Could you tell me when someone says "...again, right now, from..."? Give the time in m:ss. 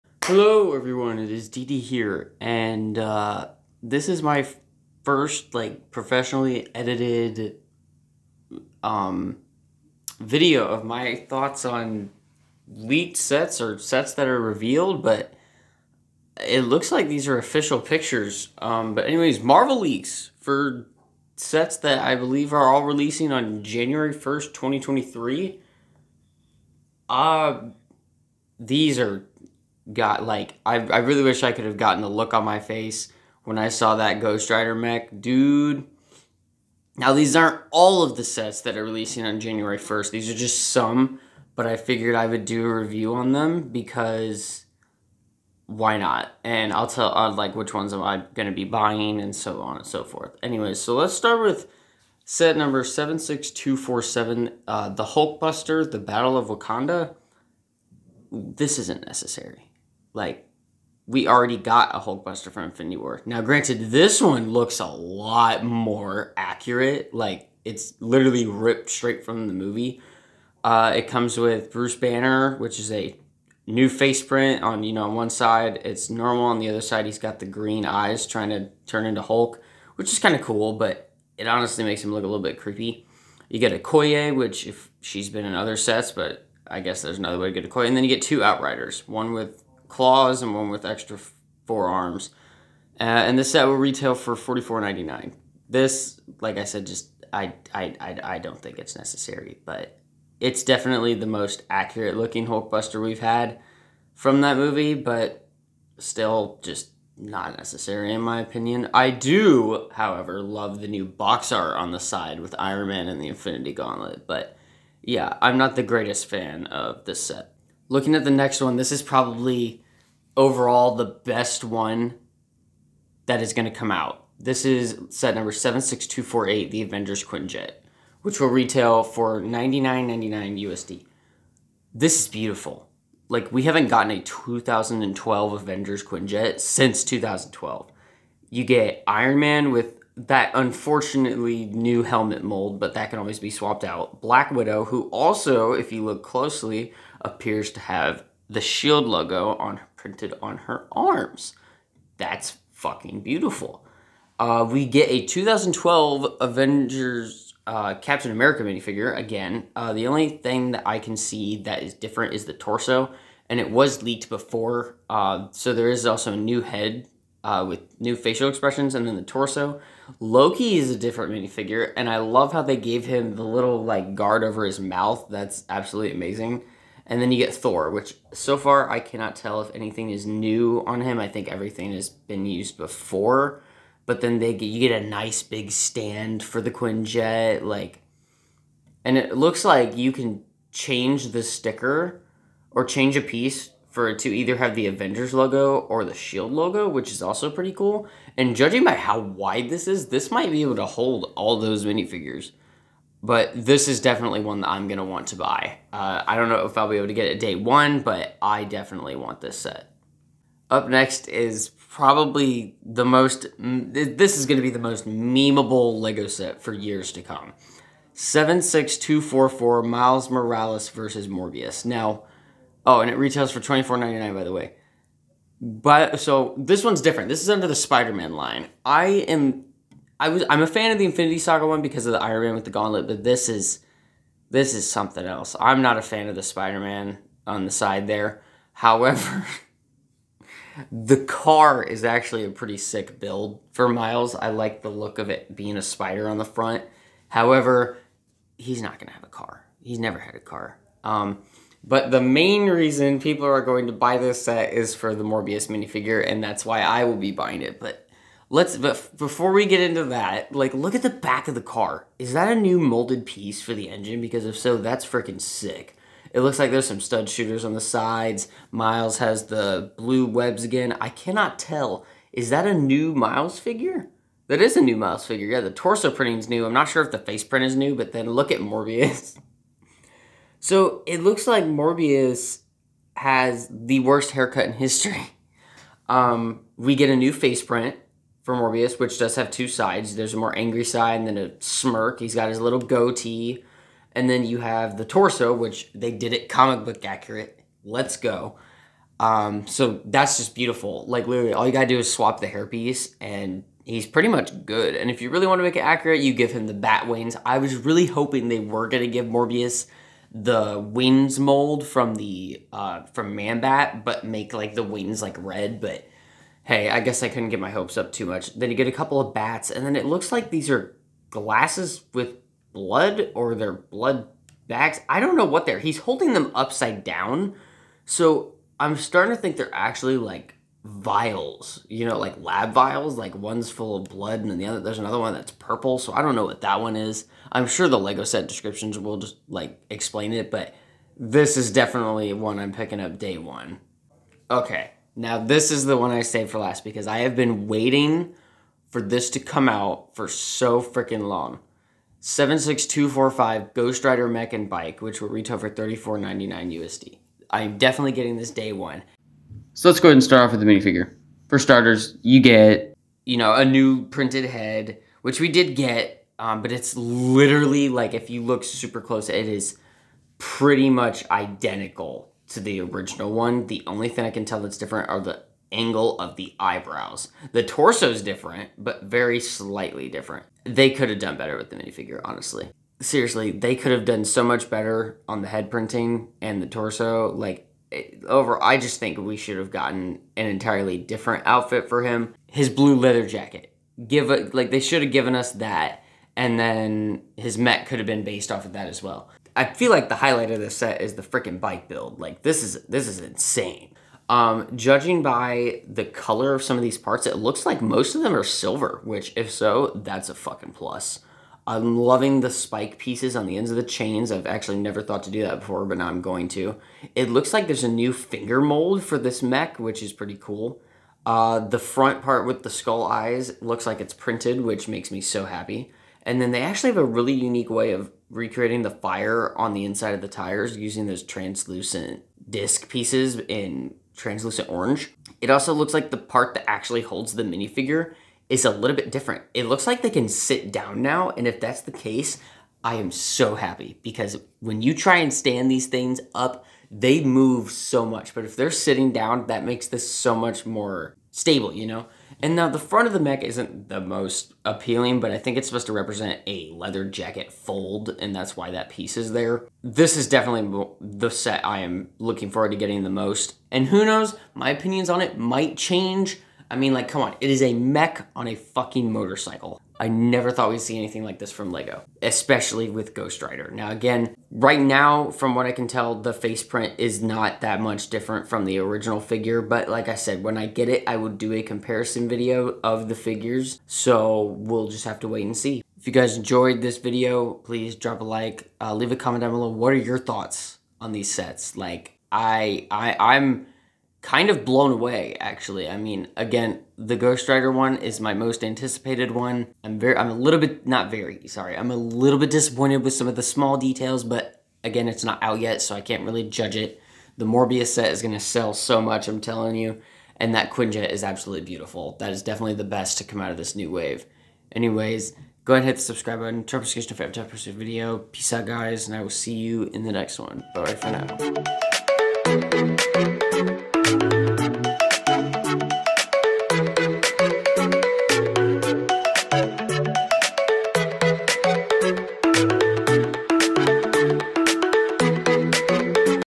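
7:53.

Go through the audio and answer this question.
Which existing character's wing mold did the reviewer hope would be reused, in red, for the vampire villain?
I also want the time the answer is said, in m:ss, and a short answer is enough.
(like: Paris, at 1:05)
Manbat, at 5:13.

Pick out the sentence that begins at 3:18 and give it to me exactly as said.
And judging by how wide this is, this might be able to hold all those minifigures.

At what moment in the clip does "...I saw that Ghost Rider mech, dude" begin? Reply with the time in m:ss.
0:33.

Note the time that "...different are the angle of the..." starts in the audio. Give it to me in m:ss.
6:14.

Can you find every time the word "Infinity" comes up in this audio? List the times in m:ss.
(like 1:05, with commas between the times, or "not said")
1:02, 1:53, 3:51.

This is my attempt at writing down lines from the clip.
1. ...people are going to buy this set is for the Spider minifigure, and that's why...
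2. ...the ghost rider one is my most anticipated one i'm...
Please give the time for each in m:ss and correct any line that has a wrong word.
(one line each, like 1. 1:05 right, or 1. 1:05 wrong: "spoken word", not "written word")
1. 4:13 wrong: "Morbius", not "Spider"
2. 8:16 right.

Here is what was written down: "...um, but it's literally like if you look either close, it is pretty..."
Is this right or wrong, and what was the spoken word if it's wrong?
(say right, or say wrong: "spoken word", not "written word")
wrong: "super", not "either".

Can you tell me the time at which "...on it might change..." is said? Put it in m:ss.
7:45.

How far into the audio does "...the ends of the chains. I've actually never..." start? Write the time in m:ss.
6:53.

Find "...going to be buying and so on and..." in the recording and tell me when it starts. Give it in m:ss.
0:48.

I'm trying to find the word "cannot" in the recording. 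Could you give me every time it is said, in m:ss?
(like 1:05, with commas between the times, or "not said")
2:58, 4:31.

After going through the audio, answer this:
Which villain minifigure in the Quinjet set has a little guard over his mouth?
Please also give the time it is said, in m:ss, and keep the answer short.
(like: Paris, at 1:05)
Loki, at 2:50.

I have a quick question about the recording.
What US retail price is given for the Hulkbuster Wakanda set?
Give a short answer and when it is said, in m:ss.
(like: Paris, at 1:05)
$44.99, at 1:34.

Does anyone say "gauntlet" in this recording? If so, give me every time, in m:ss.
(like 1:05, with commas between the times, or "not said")
1:53, 3:52.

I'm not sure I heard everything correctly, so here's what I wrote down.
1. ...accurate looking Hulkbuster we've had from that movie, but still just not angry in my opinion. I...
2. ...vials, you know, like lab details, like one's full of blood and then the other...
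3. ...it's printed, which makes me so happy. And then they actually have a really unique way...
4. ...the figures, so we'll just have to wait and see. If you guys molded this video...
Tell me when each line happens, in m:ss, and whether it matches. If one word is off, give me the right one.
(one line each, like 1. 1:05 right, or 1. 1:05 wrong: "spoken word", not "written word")
1. 1:41 wrong: "necessary", not "angry"
2. 5:30 wrong: "vials", not "details"
3. 7:04 right
4. 8:03 wrong: "enjoyed", not "molded".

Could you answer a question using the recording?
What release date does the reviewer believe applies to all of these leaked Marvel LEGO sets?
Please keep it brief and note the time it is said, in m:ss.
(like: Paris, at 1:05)
January 1st, 2023, at 0:23.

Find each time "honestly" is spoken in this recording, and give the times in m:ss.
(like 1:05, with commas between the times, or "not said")
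1:21, 6:22.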